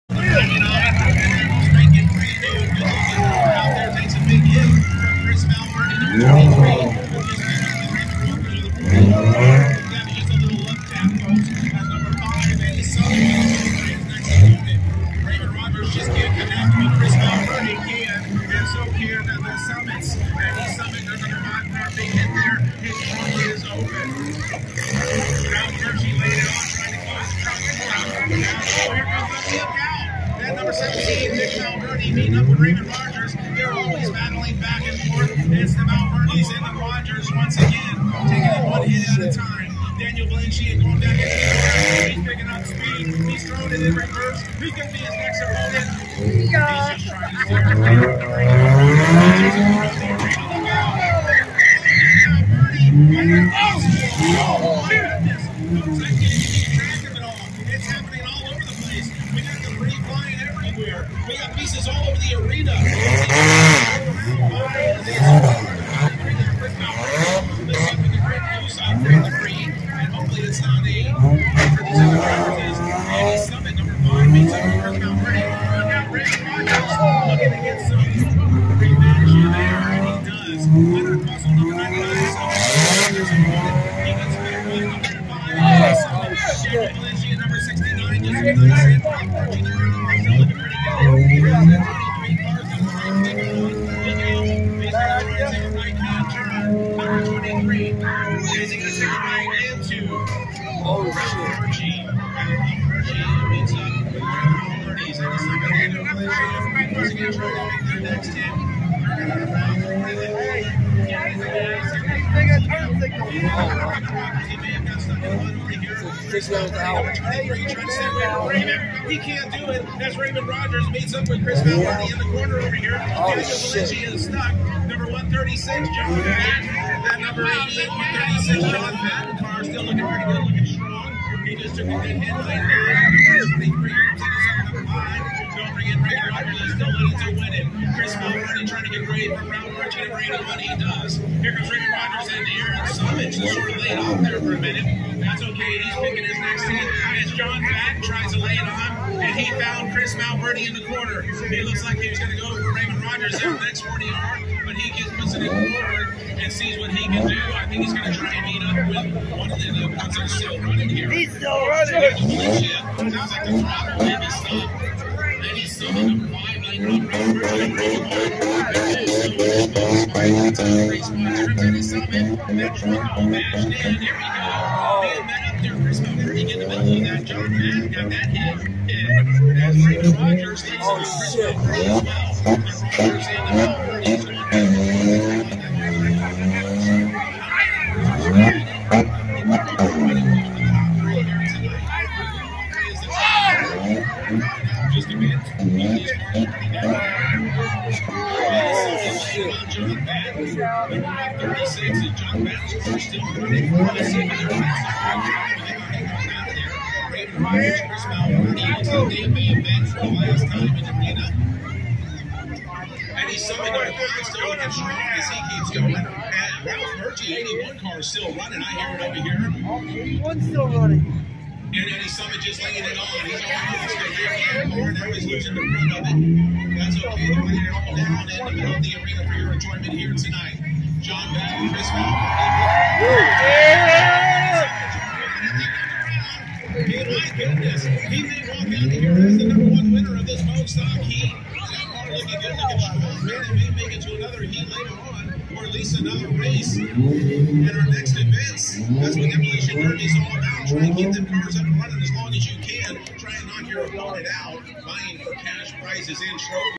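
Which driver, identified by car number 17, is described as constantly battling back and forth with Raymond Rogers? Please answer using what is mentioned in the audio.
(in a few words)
Nick Valverde.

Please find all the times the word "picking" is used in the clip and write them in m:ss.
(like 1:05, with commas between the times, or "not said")
0:42, 2:25.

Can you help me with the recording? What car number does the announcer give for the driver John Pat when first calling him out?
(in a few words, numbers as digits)
136.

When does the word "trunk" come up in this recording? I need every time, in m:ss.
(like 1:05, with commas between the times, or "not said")
0:23, 0:27.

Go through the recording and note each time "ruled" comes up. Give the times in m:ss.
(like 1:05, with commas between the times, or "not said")
not said.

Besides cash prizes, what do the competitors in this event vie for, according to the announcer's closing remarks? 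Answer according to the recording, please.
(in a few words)
trophies.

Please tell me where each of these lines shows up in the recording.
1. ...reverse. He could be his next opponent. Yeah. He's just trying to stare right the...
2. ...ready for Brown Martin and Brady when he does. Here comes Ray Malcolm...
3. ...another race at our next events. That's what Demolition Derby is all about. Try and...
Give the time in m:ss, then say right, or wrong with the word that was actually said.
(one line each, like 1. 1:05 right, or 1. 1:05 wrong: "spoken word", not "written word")
1. 0:43 right
2. 2:19 wrong: "Rogers", not "Malcolm"
3. 4:05 right.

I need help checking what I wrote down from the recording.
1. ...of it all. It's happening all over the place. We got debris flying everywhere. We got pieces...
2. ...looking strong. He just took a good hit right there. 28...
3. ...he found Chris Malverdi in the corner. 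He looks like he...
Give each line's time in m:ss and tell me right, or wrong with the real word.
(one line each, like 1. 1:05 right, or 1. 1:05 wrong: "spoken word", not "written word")
1. 0:57 right
2. 2:10 wrong: "23", not "28"
3. 2:29 right.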